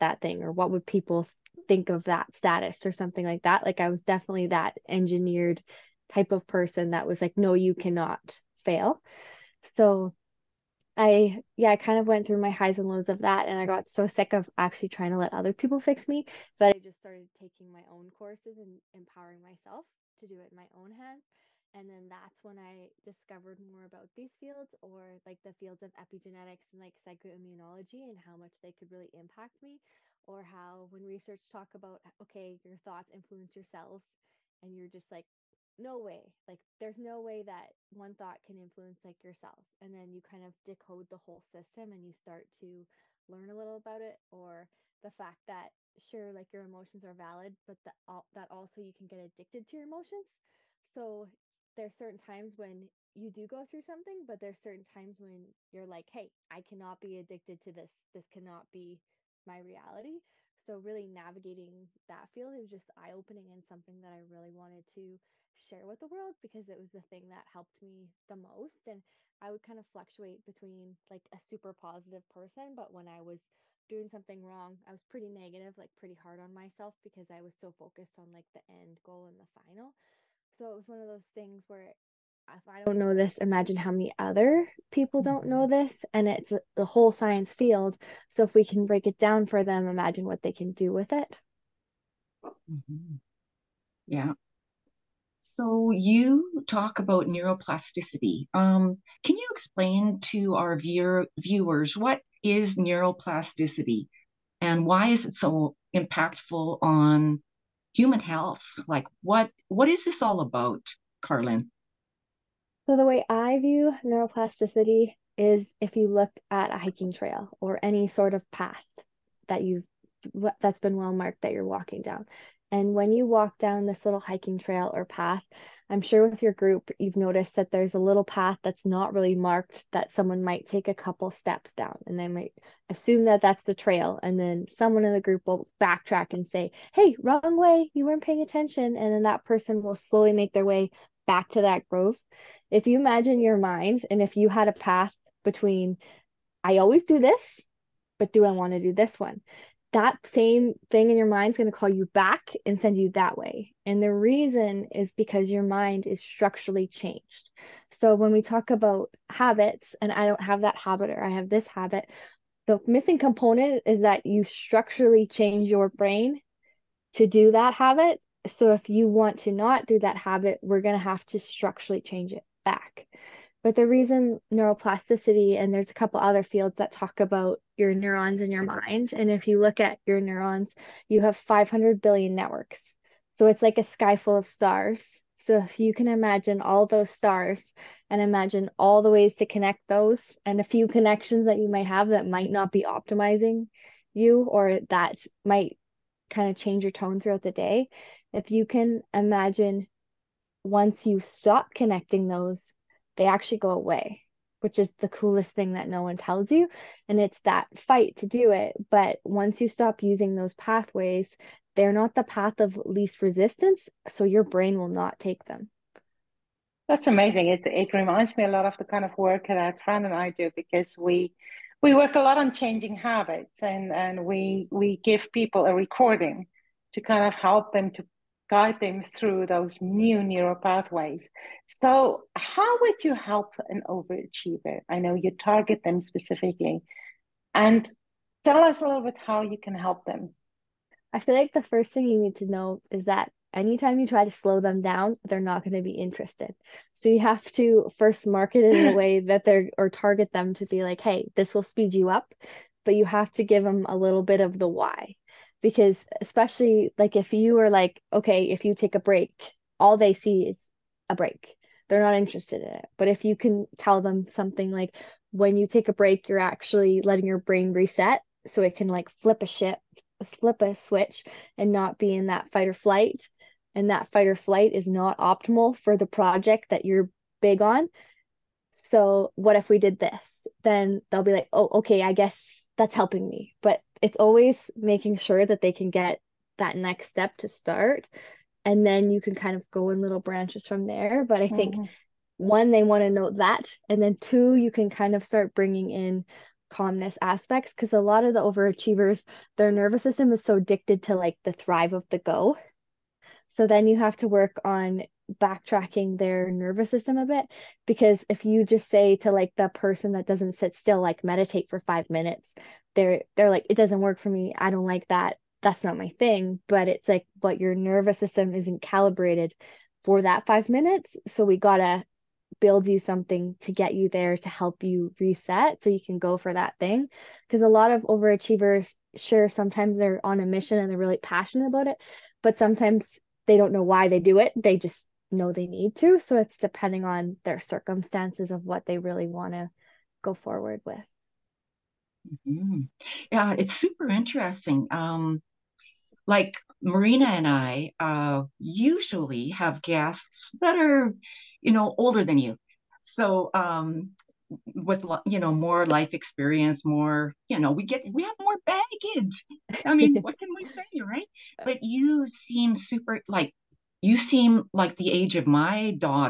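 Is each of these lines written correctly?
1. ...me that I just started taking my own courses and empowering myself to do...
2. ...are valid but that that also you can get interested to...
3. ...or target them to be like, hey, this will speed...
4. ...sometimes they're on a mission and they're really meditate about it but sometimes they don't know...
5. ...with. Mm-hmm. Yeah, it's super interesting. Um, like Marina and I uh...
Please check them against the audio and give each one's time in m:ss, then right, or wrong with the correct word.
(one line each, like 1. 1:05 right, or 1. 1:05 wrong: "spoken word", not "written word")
1. 0:16 right
2. 0:47 wrong: "addicted", not "interested"
3. 4:09 right
4. 5:29 wrong: "passionate", not "meditate"
5. 5:40 right.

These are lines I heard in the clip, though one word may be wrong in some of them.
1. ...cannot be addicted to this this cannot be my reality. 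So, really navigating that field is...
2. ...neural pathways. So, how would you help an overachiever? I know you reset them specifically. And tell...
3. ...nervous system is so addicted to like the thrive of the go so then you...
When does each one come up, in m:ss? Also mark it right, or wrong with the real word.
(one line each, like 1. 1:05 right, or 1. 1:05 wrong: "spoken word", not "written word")
1. 0:56 right
2. 3:50 wrong: "target", not "reset"
3. 4:59 right.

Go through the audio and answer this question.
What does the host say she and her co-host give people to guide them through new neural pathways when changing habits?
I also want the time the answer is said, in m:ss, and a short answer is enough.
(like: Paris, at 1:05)
a recording, at 3:45.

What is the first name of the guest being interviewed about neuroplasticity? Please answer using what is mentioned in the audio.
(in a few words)
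Karlyn.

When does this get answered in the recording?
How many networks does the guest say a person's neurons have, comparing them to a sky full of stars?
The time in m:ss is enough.
3:01.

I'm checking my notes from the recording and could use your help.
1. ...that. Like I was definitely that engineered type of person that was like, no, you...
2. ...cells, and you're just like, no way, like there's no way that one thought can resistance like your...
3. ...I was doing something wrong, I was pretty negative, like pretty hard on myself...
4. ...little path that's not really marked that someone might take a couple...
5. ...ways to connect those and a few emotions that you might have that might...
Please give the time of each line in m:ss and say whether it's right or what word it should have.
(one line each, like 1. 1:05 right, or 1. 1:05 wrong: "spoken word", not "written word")
1. 0:03 right
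2. 0:33 wrong: "influence", not "resistance"
3. 1:13 right
4. 2:07 right
5. 3:09 wrong: "connections", not "emotions".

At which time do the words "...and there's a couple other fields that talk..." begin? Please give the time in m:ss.
2:55.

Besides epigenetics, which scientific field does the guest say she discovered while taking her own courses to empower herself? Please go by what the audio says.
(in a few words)
psychoimmunology.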